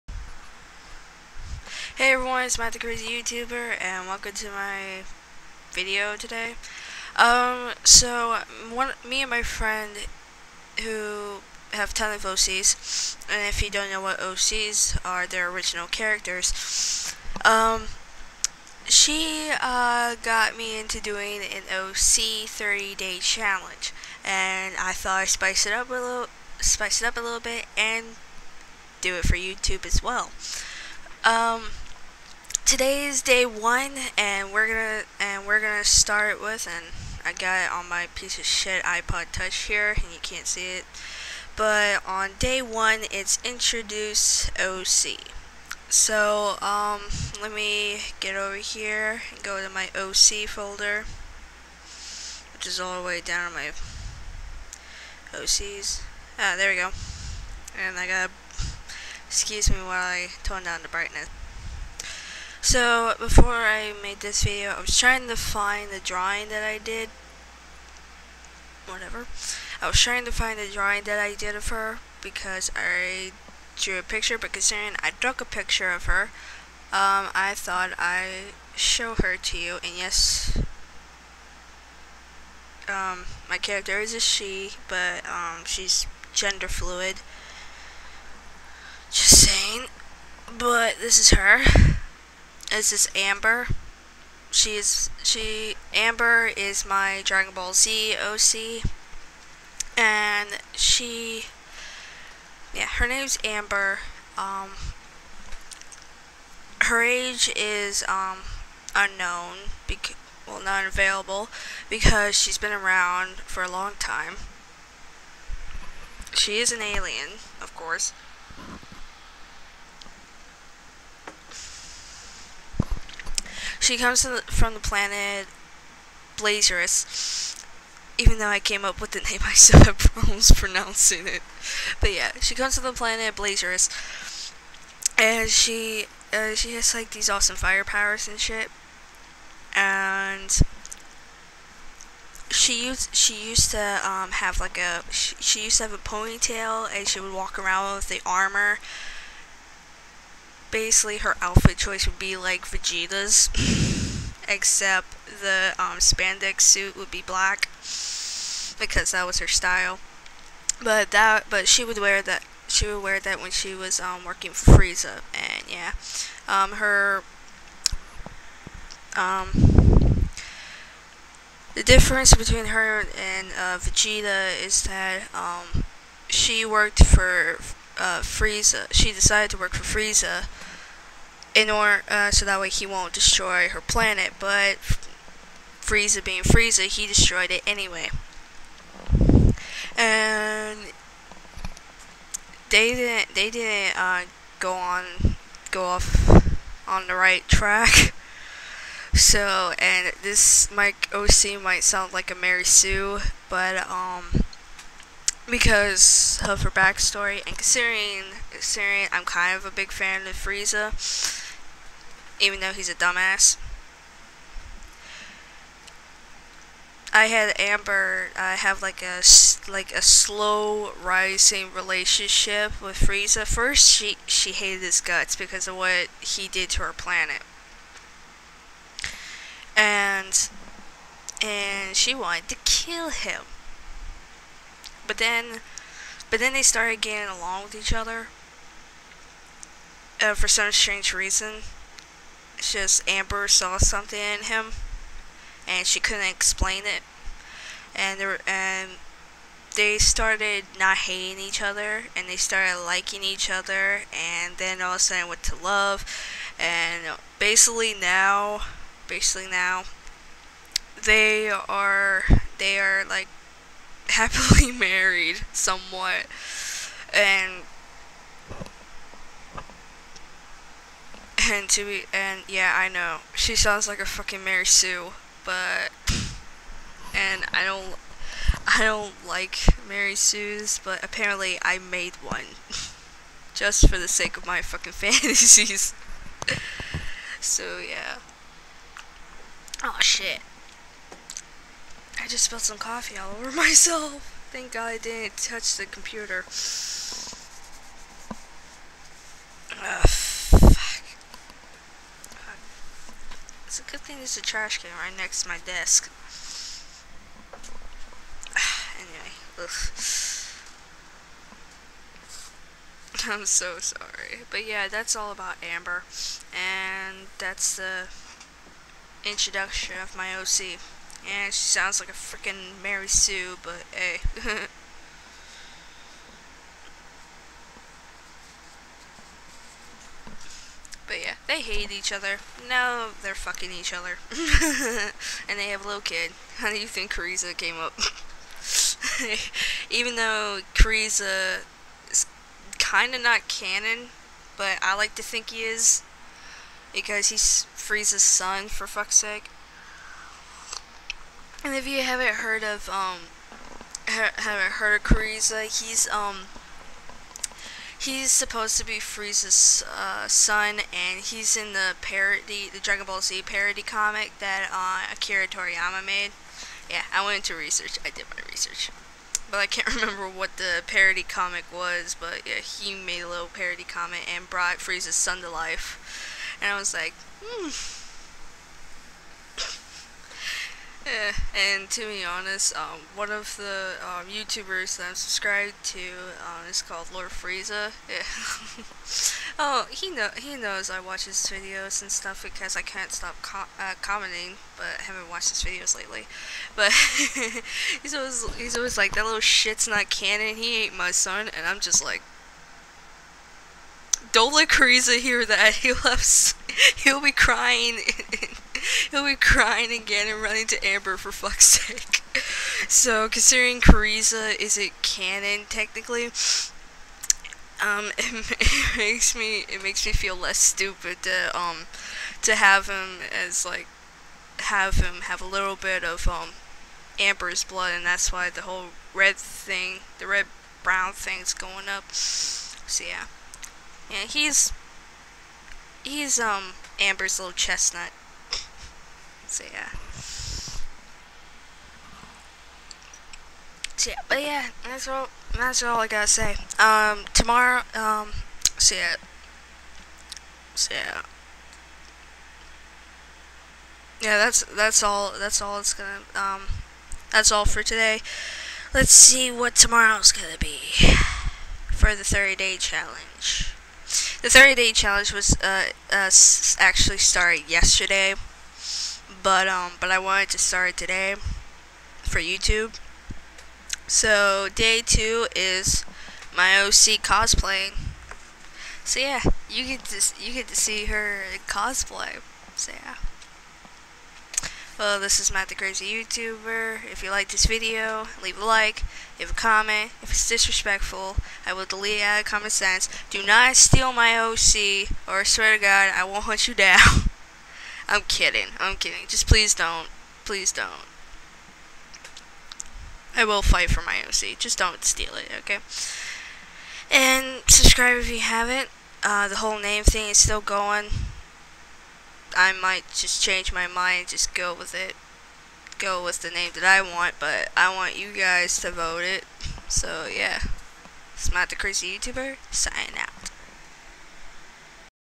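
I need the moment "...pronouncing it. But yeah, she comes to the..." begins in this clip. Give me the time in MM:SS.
02:10.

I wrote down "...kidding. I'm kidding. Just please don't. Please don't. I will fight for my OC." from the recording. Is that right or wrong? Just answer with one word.
right.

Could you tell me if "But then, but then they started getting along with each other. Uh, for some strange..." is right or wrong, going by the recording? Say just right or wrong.
right.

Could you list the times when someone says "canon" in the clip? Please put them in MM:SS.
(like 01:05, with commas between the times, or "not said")
05:43, 06:40, 06:55.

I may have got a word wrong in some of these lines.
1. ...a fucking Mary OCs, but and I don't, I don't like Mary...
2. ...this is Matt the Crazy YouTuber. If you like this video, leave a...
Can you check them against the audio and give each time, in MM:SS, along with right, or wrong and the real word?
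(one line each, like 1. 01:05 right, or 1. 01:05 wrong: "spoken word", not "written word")
1. 04:33 wrong: "Sue", not "OCs"
2. 08:05 right.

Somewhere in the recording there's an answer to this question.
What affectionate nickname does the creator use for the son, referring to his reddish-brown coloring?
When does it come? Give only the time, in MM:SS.
07:17.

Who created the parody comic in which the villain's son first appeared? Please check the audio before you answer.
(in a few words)
Akira Toriyama.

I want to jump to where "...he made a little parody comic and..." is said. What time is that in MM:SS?
06:12.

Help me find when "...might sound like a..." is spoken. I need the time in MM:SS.
03:21.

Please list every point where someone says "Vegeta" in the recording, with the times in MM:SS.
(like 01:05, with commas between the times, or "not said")
02:32, 02:53.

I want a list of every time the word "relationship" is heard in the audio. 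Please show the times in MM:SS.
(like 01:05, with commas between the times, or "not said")
03:41.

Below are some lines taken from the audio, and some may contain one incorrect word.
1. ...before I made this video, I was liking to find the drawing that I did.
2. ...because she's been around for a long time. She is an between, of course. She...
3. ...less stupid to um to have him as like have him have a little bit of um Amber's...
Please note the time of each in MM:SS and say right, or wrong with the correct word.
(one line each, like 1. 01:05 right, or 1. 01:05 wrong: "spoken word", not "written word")
1. 01:03 wrong: "trying", not "liking"
2. 01:51 wrong: "alien", not "between"
3. 07:00 right.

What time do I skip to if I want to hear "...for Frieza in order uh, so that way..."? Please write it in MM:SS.
02:59.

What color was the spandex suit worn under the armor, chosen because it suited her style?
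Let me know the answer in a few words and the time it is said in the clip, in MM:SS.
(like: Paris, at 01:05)
Black, at 02:37.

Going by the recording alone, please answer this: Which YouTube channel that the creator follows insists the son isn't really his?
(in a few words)
Lord Frieza.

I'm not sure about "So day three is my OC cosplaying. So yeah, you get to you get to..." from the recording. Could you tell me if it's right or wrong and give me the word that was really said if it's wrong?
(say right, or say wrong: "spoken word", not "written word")
wrong: "two", not "three".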